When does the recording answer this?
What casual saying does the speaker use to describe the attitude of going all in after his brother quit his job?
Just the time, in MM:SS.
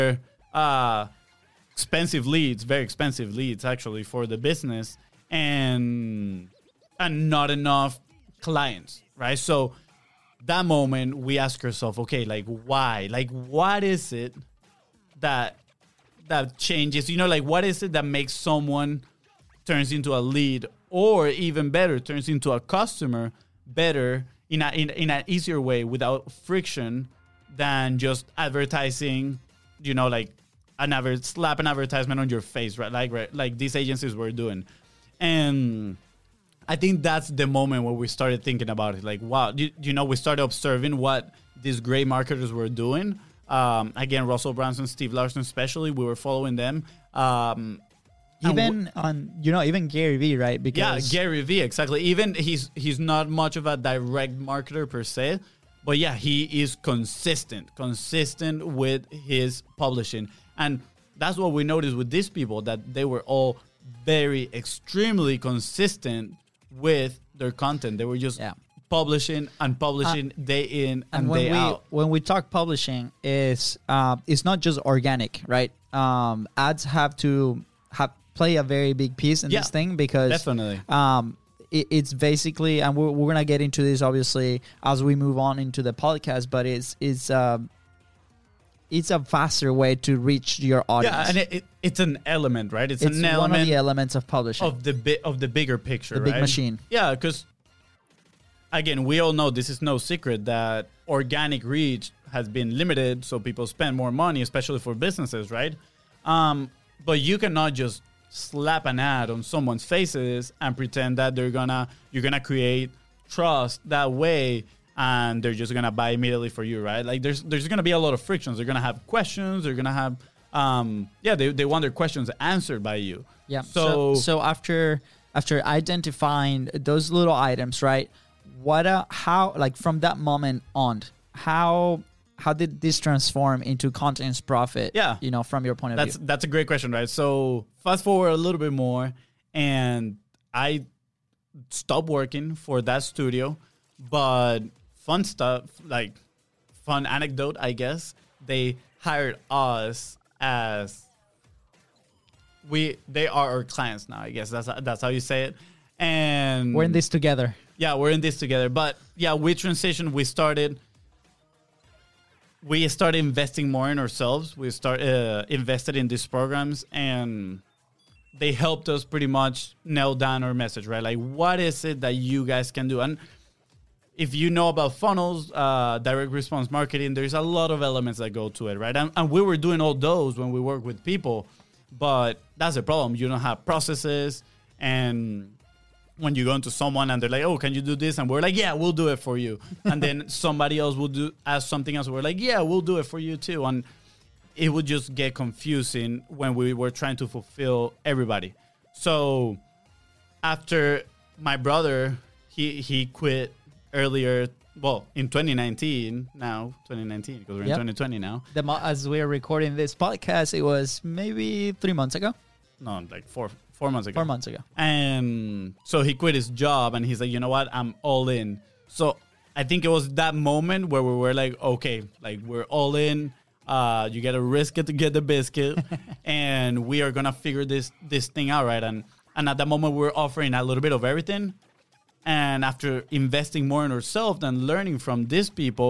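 03:44.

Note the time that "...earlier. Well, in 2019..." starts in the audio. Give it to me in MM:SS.
03:23.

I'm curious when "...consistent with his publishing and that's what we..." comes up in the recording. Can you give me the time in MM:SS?
00:57.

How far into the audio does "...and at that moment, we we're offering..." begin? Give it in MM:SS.
03:49.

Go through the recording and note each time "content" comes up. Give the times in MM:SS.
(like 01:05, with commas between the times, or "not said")
01:07, 02:13.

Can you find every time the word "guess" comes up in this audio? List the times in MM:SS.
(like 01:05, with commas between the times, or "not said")
02:27, 02:34.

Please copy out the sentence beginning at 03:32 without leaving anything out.
No, like four, four months ago.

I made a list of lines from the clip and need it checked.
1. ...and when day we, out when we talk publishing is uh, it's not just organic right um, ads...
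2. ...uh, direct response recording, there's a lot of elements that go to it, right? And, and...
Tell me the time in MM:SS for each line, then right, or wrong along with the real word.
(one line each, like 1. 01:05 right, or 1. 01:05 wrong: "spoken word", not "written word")
1. 01:11 right
2. 02:55 wrong: "marketing", not "recording".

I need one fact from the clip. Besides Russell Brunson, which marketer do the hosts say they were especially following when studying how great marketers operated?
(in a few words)
Steve Larsen.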